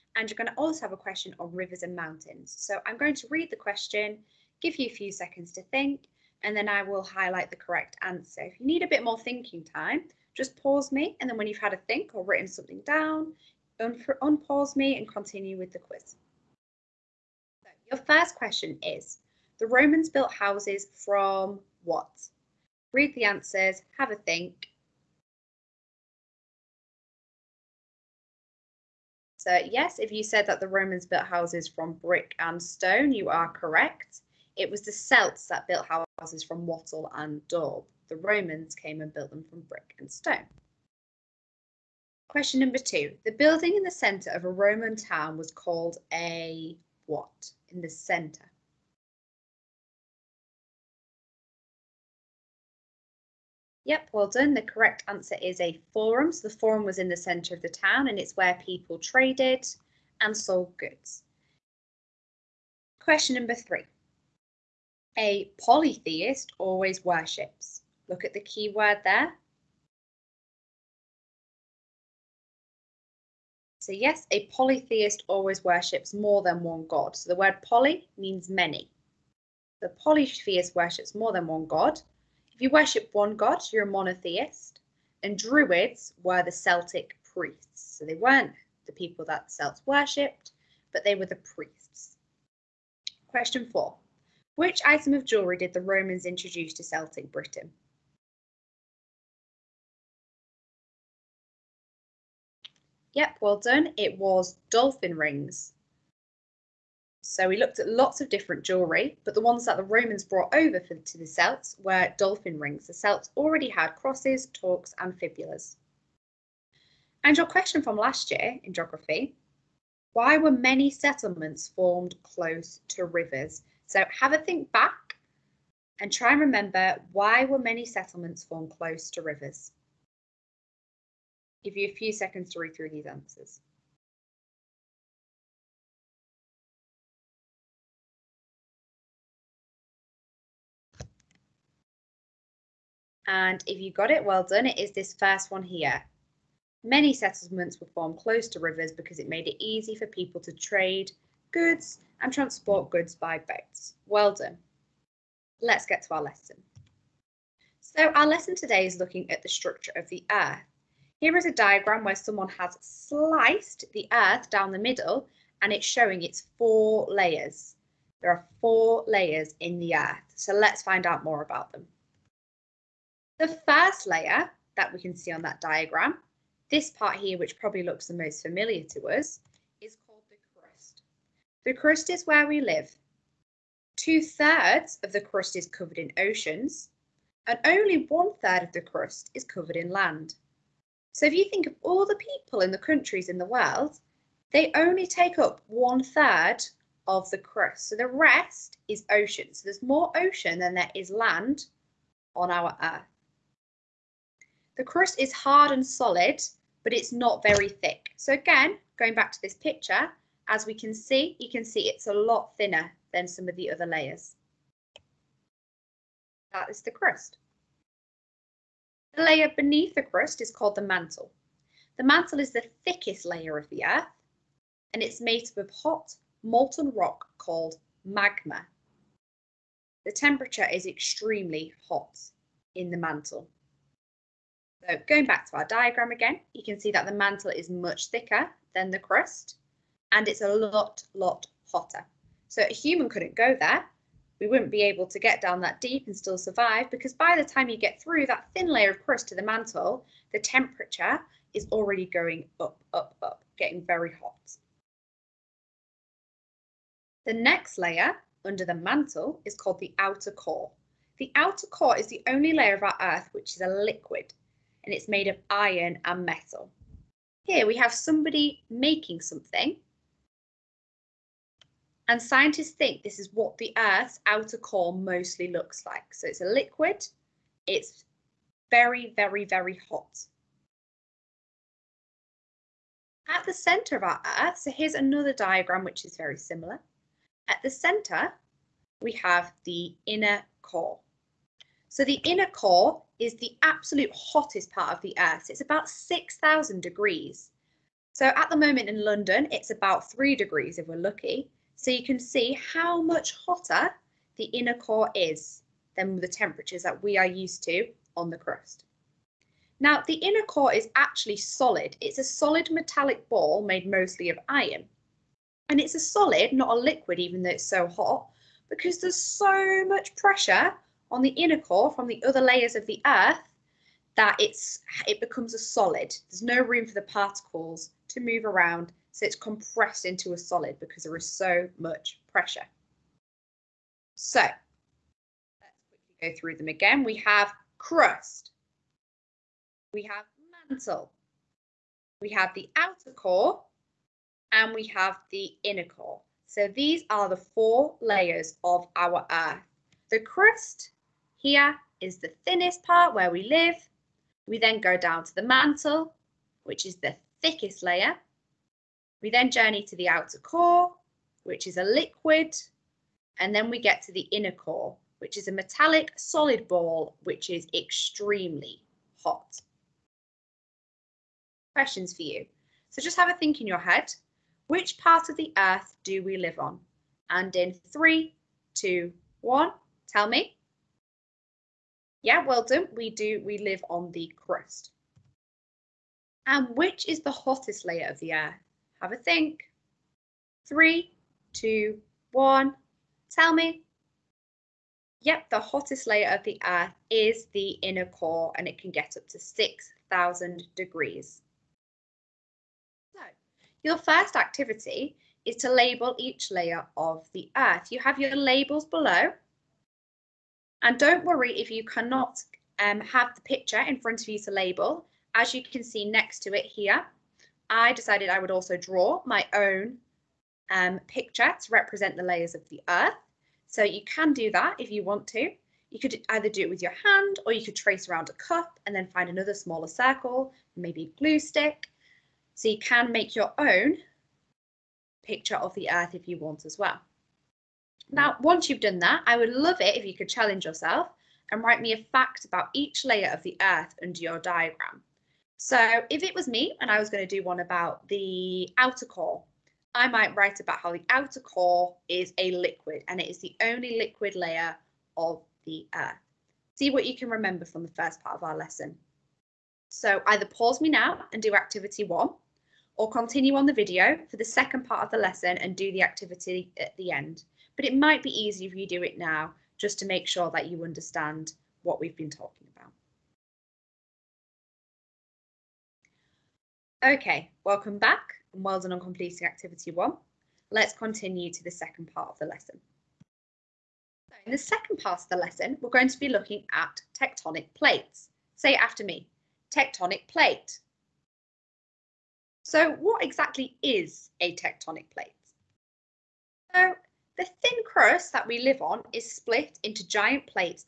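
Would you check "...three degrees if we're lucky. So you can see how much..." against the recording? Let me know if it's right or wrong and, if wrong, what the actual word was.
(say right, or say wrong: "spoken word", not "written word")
right.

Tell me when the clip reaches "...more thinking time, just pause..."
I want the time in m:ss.
0:09.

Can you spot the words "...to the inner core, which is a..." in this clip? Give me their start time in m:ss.
6:04.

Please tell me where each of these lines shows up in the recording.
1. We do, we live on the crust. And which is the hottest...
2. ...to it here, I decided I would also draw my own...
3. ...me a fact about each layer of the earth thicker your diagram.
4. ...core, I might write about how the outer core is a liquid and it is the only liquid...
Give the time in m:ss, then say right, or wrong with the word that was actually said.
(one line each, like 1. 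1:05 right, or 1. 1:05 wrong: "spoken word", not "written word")
1. 6:22 right
2. 6:56 right
3. 7:21 wrong: "under", not "thicker"
4. 7:29 right.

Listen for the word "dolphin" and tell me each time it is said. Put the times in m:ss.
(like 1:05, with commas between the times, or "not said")
1:44, 1:52.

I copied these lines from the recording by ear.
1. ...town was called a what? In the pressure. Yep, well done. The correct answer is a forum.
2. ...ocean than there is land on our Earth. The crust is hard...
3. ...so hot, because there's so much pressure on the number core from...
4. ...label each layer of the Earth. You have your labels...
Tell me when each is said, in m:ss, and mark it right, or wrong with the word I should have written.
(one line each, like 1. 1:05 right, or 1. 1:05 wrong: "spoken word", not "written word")
1. 0:44 wrong: "centre", not "pressure"
2. 3:20 right
3. 5:17 wrong: "inner", not "number"
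4. 6:45 right.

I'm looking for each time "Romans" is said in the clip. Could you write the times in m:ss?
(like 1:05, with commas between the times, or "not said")
0:19, 0:30, 0:38, 0:44, 1:35, 1:49.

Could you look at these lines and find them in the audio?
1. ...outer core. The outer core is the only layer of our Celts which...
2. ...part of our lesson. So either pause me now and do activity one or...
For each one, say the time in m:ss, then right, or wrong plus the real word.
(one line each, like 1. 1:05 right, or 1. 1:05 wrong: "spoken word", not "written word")
1. 4:19 wrong: "Earth", not "Celts"
2. 7:38 right.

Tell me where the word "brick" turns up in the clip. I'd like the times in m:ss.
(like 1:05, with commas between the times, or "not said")
0:31, 0:39.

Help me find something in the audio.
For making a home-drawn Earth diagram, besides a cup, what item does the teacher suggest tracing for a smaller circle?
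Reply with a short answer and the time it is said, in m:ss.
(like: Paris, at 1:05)
Glue stick, at 7:11.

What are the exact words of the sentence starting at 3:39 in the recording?
The layer beneath the crust is called the mantle.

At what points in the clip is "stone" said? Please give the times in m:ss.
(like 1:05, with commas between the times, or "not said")
0:32, 0:40.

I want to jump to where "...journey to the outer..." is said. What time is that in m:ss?
5:59.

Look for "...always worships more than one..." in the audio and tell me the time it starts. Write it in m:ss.
1:15.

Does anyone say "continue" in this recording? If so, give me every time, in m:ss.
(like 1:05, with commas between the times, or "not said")
0:15, 7:43, 8:00.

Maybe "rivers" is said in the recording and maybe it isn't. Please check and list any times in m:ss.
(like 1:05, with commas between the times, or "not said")
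0:01, 2:03, 2:09, 2:28.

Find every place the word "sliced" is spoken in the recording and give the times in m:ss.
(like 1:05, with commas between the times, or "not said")
2:42.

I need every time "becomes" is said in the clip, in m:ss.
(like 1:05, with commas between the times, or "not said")
5:25.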